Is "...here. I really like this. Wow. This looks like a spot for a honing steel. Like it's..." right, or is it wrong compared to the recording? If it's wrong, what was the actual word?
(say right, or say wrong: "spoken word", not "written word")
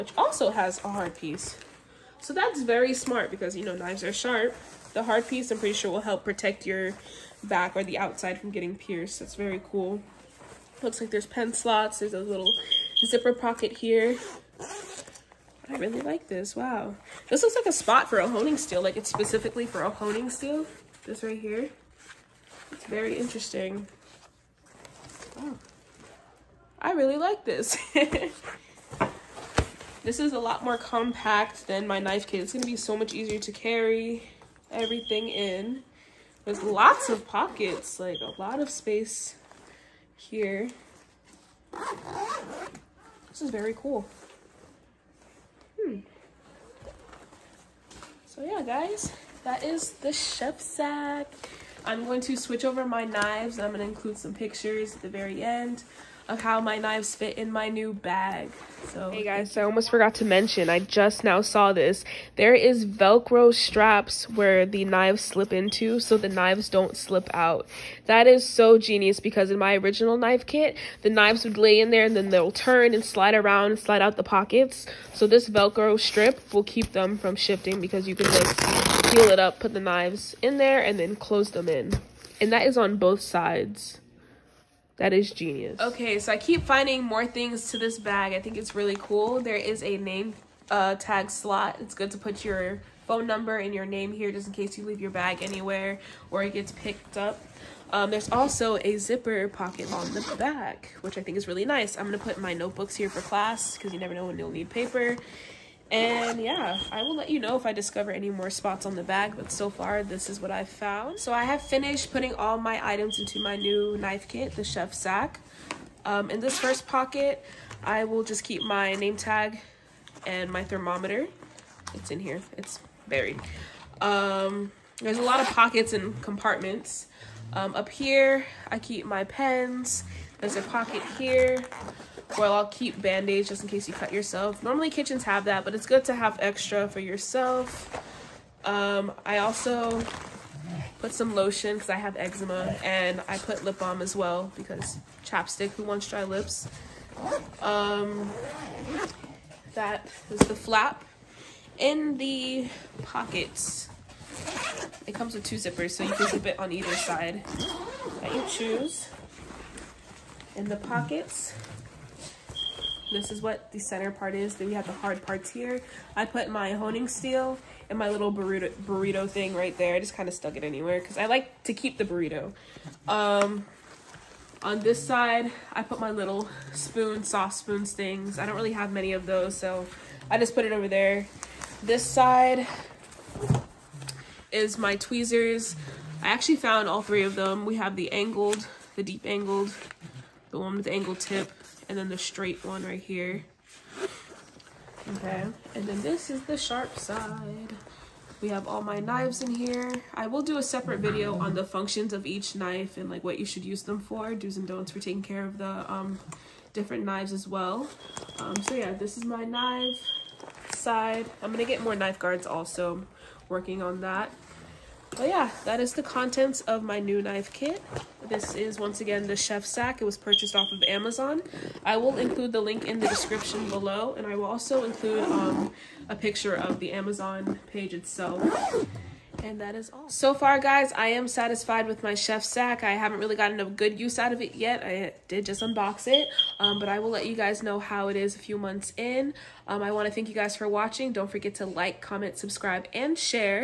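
right.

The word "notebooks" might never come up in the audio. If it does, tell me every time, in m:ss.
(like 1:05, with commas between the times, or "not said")
1:42.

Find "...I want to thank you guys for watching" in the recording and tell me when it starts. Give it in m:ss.
3:59.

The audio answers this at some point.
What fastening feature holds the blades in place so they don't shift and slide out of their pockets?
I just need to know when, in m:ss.
1:02.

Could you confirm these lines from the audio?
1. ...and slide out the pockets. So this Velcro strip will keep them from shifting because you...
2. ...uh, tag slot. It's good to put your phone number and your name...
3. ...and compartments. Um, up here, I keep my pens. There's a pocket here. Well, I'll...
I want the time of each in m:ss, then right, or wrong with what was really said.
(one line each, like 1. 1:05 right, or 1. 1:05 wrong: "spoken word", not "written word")
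1. 1:13 right
2. 1:30 right
3. 2:05 right.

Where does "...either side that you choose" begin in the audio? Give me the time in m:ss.
2:36.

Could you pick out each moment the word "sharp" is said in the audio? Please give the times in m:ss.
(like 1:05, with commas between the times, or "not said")
0:04, 3:16.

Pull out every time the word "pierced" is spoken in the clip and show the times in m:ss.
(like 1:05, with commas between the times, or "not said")
0:08.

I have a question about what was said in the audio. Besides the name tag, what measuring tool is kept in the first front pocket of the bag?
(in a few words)
Thermometer.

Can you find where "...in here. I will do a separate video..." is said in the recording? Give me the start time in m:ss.
3:19.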